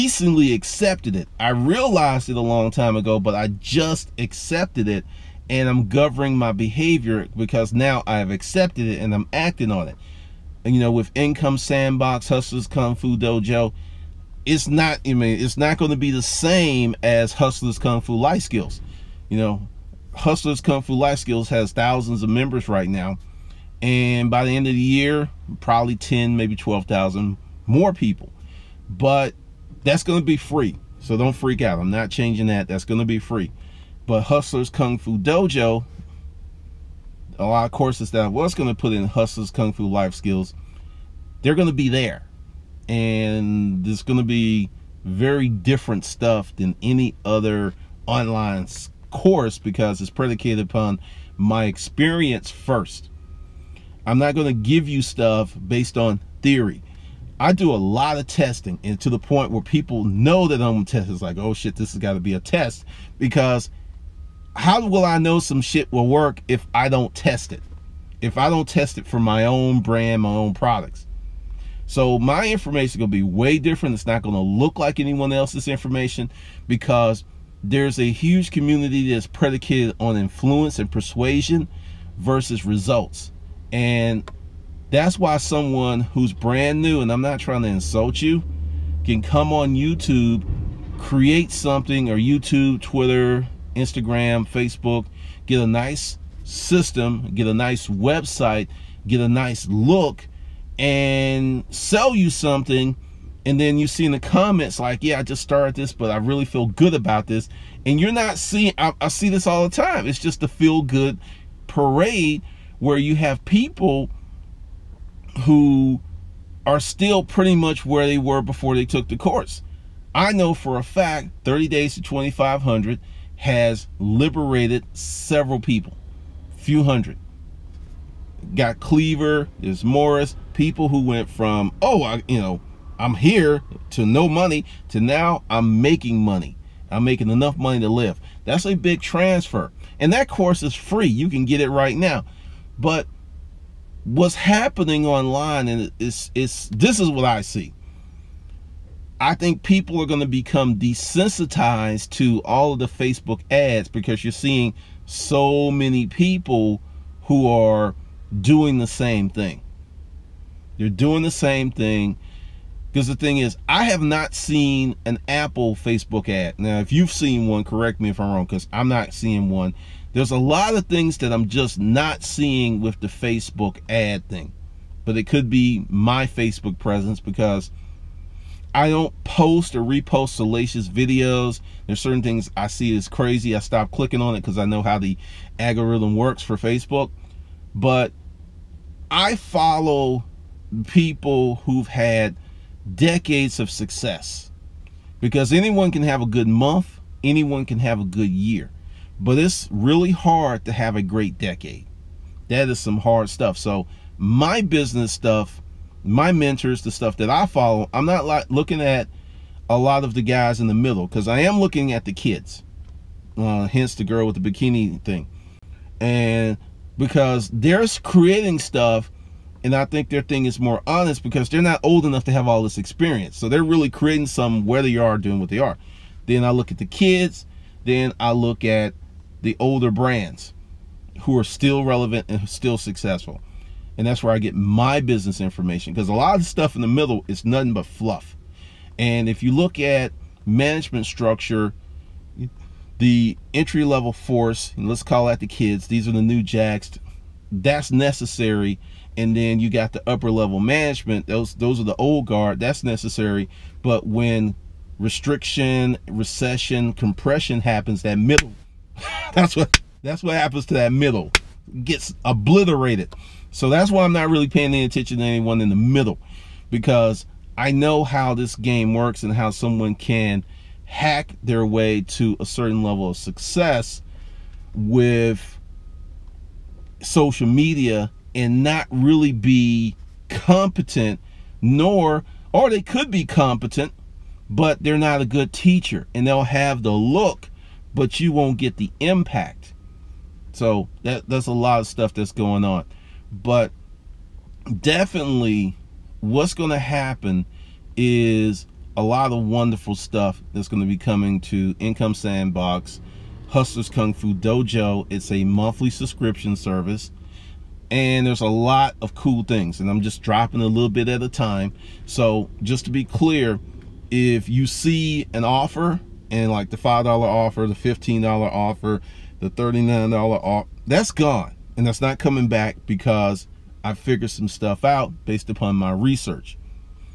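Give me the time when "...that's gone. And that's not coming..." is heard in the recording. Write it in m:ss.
5:20.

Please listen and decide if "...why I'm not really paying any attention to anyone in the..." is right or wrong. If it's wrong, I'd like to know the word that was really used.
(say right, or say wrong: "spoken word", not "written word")
right.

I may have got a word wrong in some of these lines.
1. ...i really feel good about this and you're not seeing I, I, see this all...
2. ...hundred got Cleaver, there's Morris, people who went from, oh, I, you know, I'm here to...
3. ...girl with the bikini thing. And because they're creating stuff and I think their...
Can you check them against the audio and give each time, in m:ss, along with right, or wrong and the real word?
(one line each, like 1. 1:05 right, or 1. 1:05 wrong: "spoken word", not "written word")
1. 1:46 right
2. 2:06 right
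3. 3:34 right.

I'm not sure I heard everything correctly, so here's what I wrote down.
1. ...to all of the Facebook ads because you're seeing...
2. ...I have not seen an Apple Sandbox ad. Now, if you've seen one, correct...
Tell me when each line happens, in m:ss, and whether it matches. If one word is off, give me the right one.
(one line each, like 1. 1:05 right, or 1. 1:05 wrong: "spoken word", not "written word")
1. 2:32 right
2. 2:43 wrong: "Facebook", not "Sandbox".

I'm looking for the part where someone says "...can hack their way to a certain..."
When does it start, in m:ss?
4:29.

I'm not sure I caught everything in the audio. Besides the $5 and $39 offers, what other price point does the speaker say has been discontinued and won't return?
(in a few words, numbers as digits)
$15.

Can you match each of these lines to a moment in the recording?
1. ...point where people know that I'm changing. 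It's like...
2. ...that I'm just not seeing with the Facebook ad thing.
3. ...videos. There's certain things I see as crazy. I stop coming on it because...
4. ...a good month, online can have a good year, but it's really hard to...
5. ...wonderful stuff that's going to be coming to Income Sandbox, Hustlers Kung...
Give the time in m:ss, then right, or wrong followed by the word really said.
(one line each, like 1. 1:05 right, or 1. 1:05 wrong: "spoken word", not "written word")
1. 0:59 wrong: "testing", not "changing"
2. 2:51 right
3. 3:00 wrong: "clicking", not "coming"
4. 3:16 wrong: "anyone", not "online"
5. 4:59 right.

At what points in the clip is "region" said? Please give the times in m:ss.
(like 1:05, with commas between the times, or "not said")
not said.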